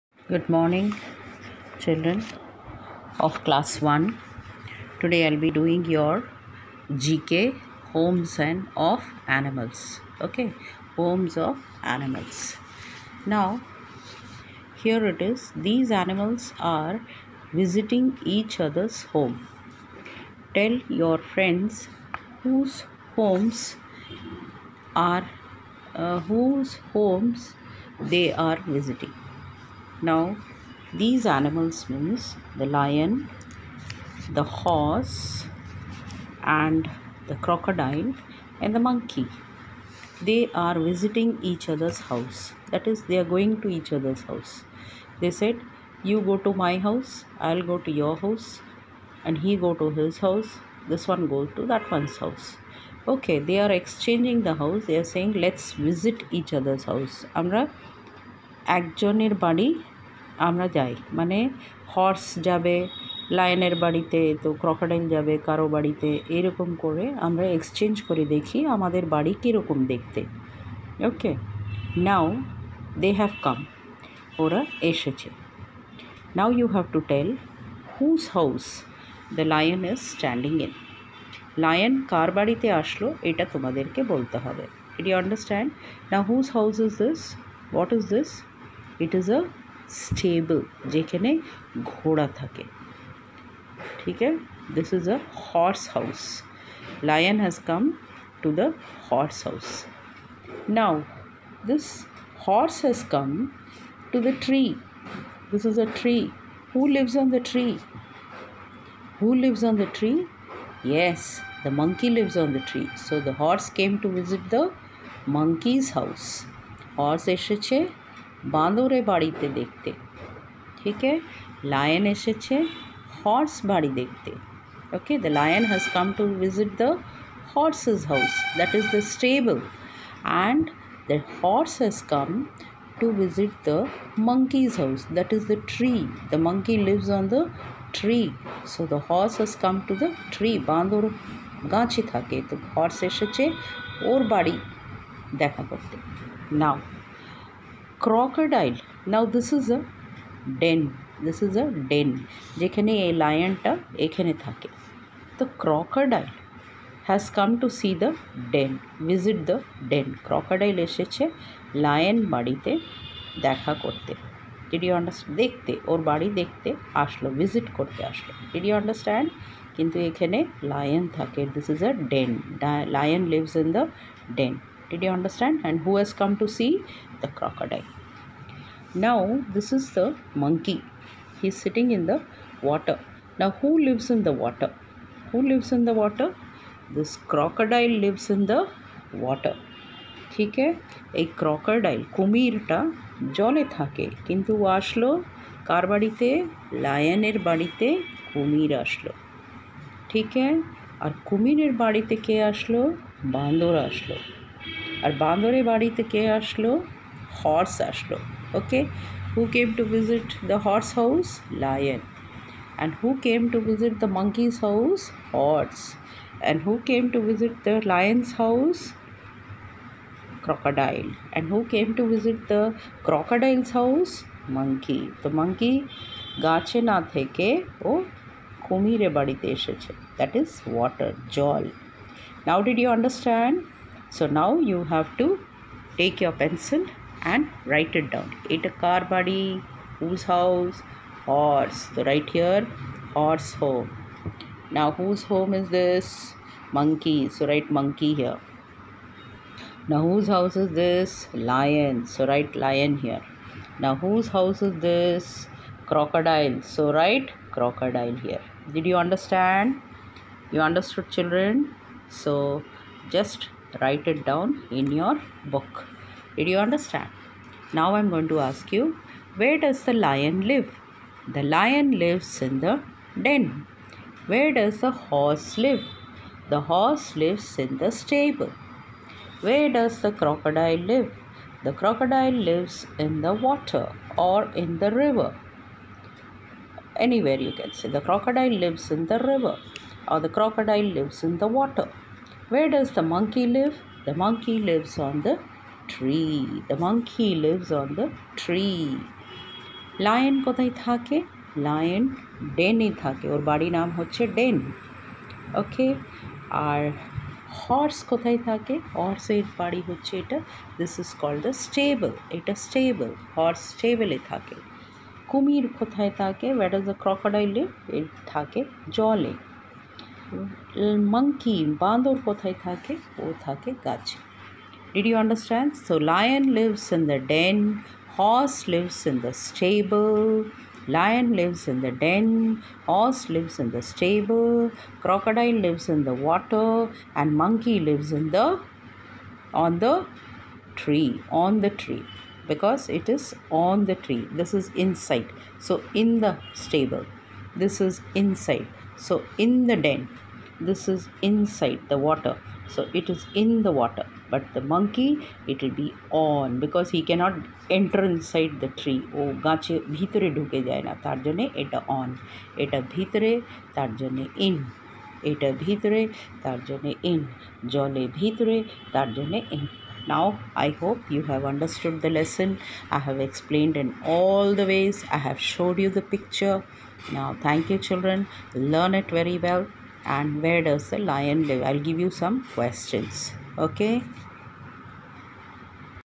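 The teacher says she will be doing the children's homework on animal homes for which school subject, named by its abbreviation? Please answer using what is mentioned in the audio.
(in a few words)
GK.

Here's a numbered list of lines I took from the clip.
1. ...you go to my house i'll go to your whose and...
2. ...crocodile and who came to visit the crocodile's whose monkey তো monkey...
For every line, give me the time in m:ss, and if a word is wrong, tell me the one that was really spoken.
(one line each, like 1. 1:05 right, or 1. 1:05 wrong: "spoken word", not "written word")
1. 0:46 wrong: "house", not "whose"
2. 3:40 wrong: "house", not "whose".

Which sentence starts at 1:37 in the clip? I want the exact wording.
lion has come to the horse house.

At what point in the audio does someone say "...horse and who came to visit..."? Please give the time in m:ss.
3:35.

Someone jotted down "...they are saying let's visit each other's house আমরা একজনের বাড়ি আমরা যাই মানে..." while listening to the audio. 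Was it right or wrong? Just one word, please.
right.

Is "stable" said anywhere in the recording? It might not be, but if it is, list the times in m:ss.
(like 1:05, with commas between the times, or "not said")
1:30, 4:38, 5:29, 5:33, 5:46.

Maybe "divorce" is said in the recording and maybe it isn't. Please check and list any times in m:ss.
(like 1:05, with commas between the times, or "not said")
not said.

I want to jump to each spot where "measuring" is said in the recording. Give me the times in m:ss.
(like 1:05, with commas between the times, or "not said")
not said.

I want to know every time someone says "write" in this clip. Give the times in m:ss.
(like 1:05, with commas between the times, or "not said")
3:57, 4:07, 4:12, 4:16, 4:23.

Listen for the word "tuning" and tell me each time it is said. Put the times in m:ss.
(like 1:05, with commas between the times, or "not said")
not said.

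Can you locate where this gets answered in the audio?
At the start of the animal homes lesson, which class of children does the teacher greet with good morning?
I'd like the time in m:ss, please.
0:03.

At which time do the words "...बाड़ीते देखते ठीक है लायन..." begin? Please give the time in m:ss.
1:59.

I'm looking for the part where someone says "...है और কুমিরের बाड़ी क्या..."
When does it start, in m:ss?
3:20.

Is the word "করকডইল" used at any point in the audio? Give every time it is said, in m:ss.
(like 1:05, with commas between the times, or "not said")
1:04, 2:35, 2:40, 3:11, 5:17.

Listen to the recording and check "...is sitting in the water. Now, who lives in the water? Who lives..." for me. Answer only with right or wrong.
right.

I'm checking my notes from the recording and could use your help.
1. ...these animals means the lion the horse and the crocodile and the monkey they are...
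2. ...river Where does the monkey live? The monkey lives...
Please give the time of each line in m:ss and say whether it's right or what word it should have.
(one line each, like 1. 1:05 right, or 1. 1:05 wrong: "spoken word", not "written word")
1. 0:30 right
2. 4:51 wrong: "water", not "river".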